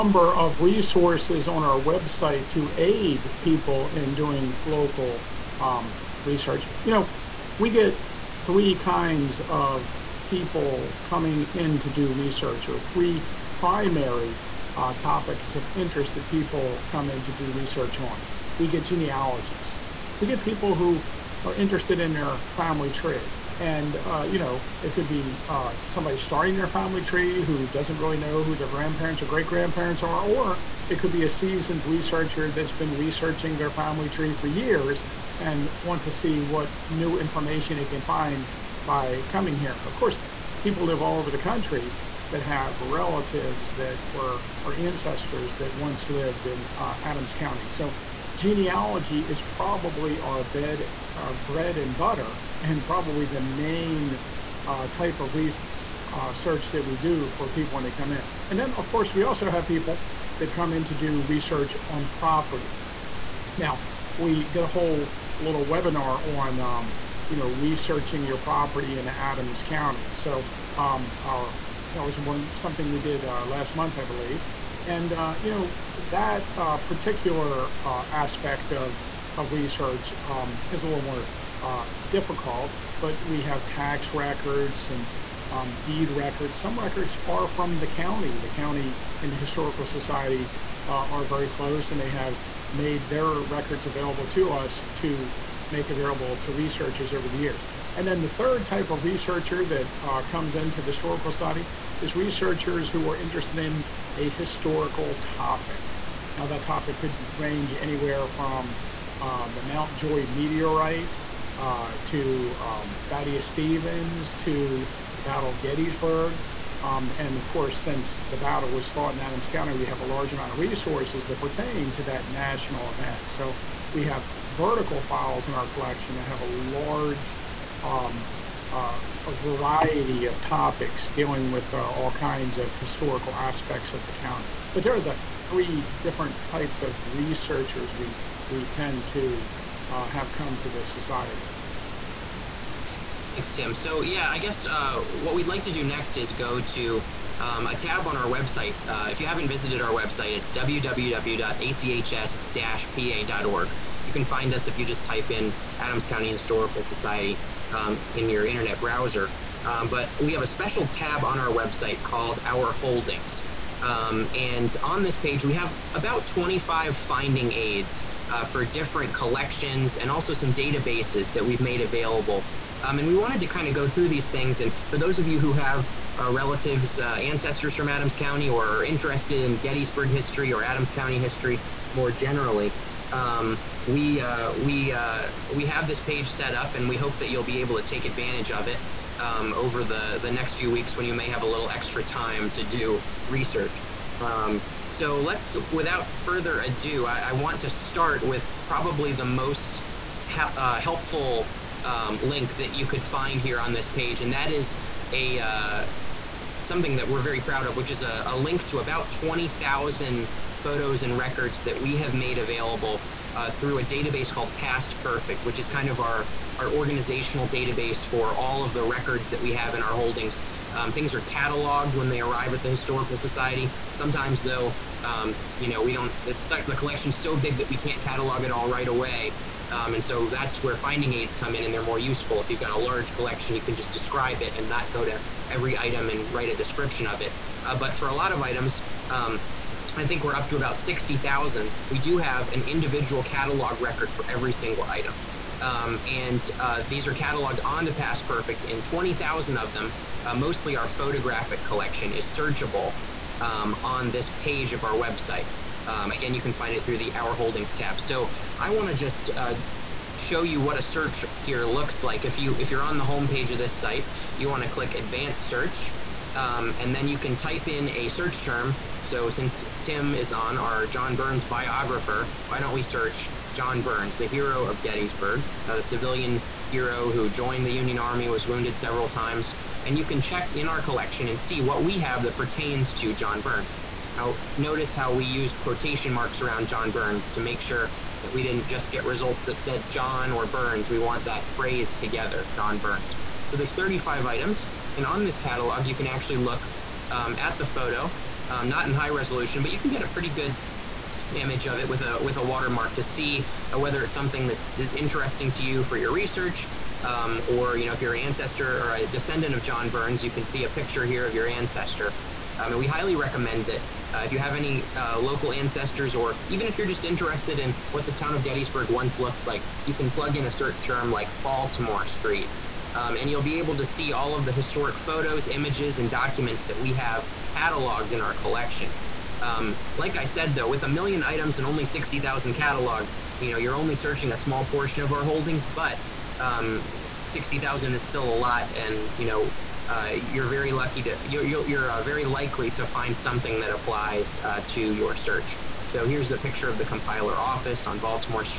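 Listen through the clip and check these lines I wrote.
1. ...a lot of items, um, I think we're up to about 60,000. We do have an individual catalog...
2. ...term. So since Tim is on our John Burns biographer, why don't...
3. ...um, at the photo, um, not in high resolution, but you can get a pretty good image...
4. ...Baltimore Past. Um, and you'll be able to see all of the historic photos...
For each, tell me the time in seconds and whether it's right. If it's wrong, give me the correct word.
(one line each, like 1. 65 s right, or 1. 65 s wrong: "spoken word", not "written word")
1. 238 s right
2. 268 s right
3. 297 s right
4. 321 s wrong: "Street", not "Past".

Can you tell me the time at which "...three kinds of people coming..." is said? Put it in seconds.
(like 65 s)
8 s.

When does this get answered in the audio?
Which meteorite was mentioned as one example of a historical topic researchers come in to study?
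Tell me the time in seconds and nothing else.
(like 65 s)
109 s.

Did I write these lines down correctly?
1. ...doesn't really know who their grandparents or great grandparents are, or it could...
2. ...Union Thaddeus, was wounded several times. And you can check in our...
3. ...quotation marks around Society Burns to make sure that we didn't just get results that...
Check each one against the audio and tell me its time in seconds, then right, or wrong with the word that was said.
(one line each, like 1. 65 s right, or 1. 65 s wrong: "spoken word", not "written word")
1. 27 s right
2. 277 s wrong: "Army", not "Thaddeus"
3. 285 s wrong: "John", not "Society".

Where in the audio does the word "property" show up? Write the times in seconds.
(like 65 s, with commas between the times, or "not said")
62 s, 68 s.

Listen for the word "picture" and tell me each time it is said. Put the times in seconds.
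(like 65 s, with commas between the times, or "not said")
310 s, 346 s.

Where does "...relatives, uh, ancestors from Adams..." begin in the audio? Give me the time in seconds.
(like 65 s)
176 s.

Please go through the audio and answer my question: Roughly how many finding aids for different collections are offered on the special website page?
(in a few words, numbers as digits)
25.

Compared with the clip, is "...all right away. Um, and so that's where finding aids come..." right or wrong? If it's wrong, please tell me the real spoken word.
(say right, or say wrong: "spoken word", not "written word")
right.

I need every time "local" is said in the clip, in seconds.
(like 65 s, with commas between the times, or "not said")
4 s, 315 s.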